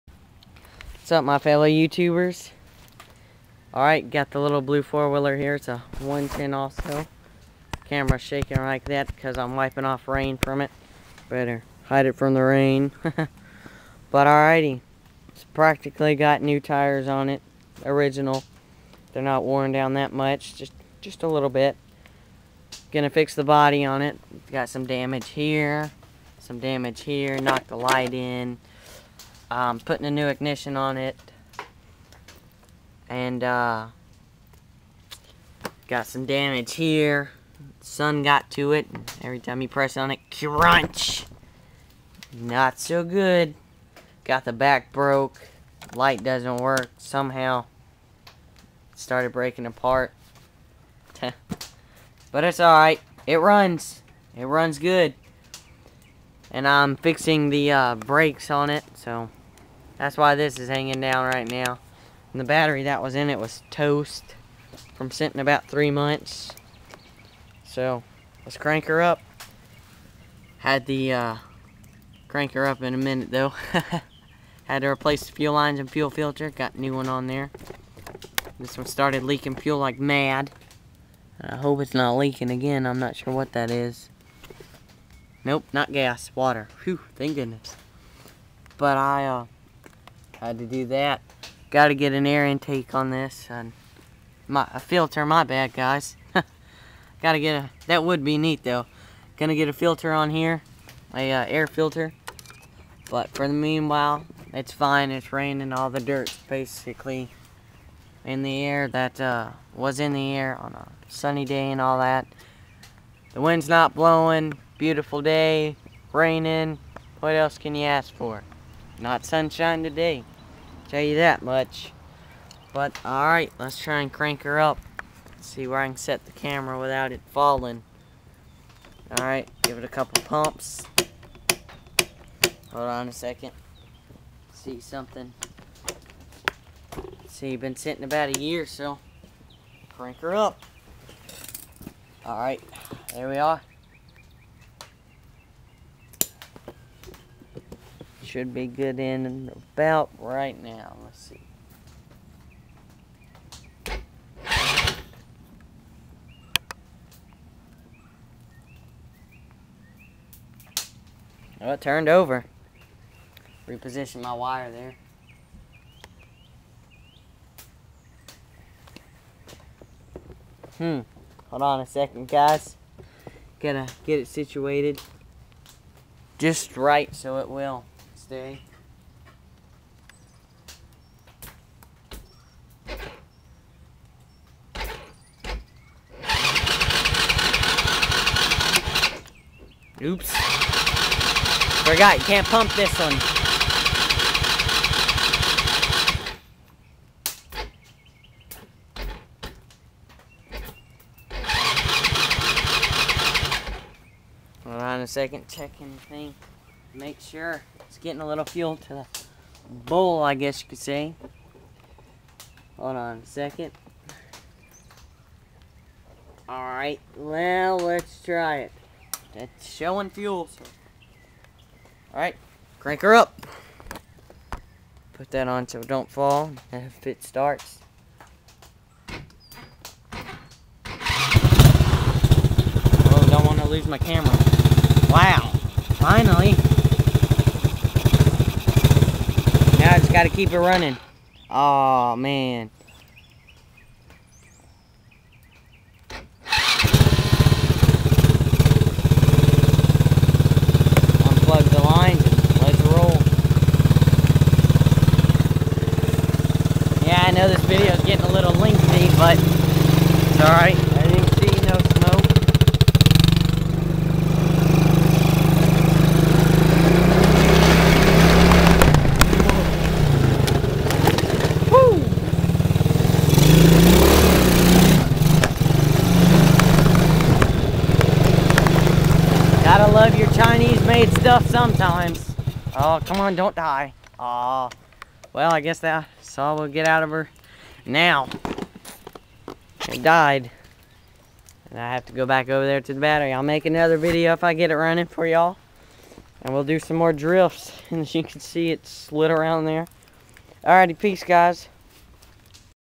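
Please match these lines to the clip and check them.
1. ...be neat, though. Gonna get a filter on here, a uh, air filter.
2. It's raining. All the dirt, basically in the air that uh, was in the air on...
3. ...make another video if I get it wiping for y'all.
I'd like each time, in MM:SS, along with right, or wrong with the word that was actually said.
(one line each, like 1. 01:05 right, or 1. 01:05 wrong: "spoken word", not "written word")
1. 01:38 right
2. 01:45 right
3. 04:53 wrong: "running", not "wiping".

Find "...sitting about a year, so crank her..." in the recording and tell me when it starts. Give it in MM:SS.
02:17.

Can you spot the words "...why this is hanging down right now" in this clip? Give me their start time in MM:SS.
01:00.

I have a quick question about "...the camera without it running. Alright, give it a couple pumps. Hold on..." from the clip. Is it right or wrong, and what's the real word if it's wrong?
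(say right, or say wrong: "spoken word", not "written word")
wrong: "falling", not "running".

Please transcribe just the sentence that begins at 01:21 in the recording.
I hope it's not leaking again.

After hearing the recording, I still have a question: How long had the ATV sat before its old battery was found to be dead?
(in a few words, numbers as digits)
about three months.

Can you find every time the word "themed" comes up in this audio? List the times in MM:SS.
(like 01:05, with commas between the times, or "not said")
not said.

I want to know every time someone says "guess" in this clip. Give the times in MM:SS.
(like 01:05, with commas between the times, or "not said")
03:30, 04:45.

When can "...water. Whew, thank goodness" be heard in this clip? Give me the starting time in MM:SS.
01:26.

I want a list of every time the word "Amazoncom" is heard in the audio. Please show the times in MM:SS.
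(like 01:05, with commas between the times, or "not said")
not said.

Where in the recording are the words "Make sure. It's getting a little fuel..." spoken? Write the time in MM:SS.
03:26.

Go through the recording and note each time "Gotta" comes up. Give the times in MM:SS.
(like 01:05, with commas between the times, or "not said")
02:53, 04:00, 04:39.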